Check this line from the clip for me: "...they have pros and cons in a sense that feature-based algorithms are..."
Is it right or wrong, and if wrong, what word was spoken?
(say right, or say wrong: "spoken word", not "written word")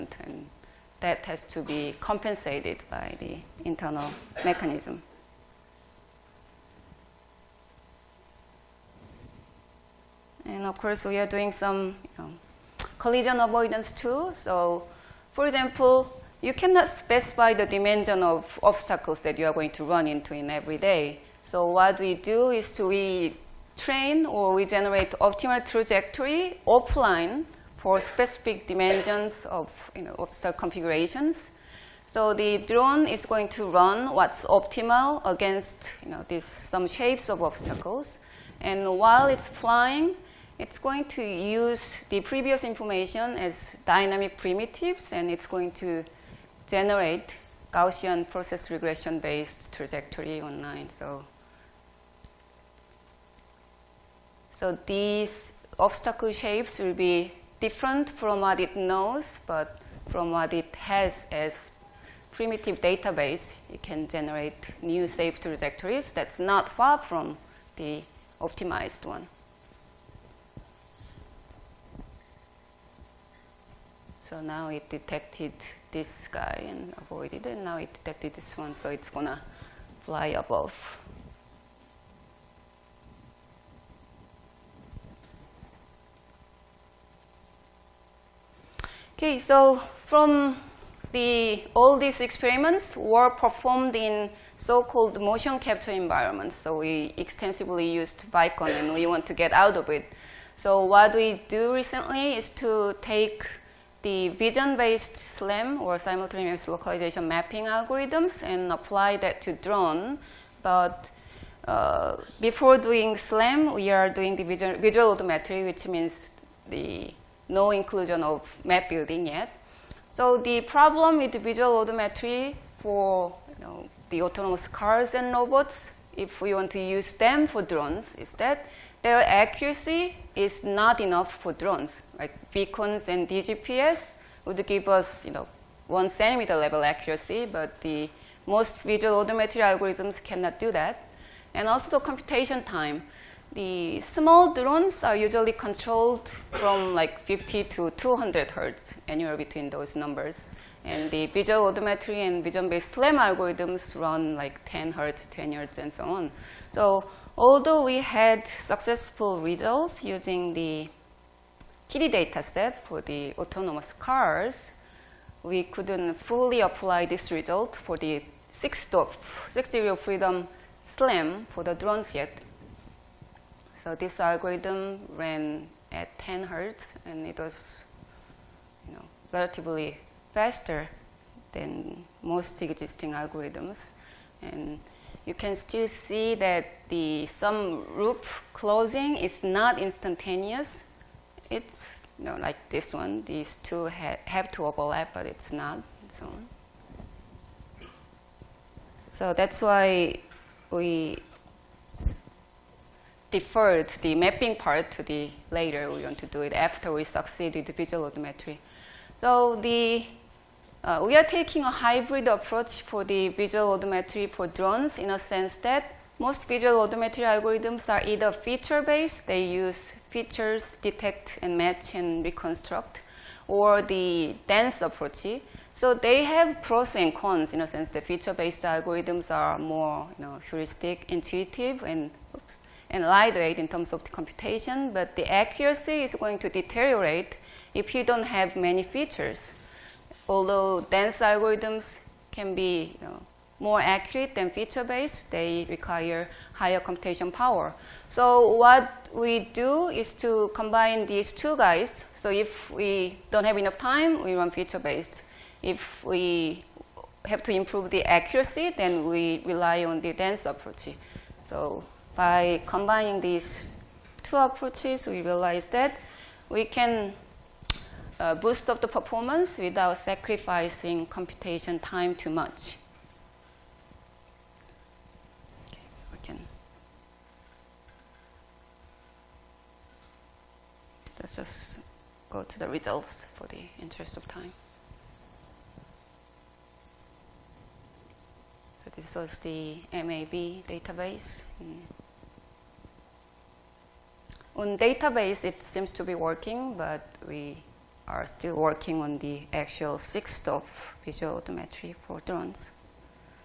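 right.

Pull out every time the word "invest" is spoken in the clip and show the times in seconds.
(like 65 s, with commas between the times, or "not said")
not said.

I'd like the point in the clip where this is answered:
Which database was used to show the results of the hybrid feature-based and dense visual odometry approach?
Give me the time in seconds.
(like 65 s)
289 s.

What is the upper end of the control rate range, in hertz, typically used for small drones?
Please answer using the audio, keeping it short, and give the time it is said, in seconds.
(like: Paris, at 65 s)
200, at 147 s.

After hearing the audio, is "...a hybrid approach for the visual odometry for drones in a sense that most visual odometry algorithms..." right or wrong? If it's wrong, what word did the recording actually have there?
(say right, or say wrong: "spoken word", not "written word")
right.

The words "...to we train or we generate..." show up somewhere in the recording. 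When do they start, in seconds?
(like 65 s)
22 s.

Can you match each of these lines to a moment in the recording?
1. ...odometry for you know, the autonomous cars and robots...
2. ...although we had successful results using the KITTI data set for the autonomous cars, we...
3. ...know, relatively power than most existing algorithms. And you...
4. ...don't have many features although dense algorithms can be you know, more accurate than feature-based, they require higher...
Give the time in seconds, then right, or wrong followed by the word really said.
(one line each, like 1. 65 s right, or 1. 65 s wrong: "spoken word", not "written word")
1. 121 s right
2. 157 s right
3. 178 s wrong: "faster", not "power"
4. 238 s right.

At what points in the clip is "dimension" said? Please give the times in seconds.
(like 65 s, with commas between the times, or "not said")
17 s, 28 s.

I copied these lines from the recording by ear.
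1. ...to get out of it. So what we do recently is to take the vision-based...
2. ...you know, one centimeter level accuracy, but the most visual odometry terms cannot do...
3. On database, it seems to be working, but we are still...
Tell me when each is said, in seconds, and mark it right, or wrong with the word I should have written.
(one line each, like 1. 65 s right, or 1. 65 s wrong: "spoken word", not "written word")
1. 99 s right
2. 135 s wrong: "algorithms", not "terms"
3. 294 s right.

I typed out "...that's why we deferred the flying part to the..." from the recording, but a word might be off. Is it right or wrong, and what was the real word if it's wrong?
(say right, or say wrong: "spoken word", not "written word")
wrong: "mapping", not "flying".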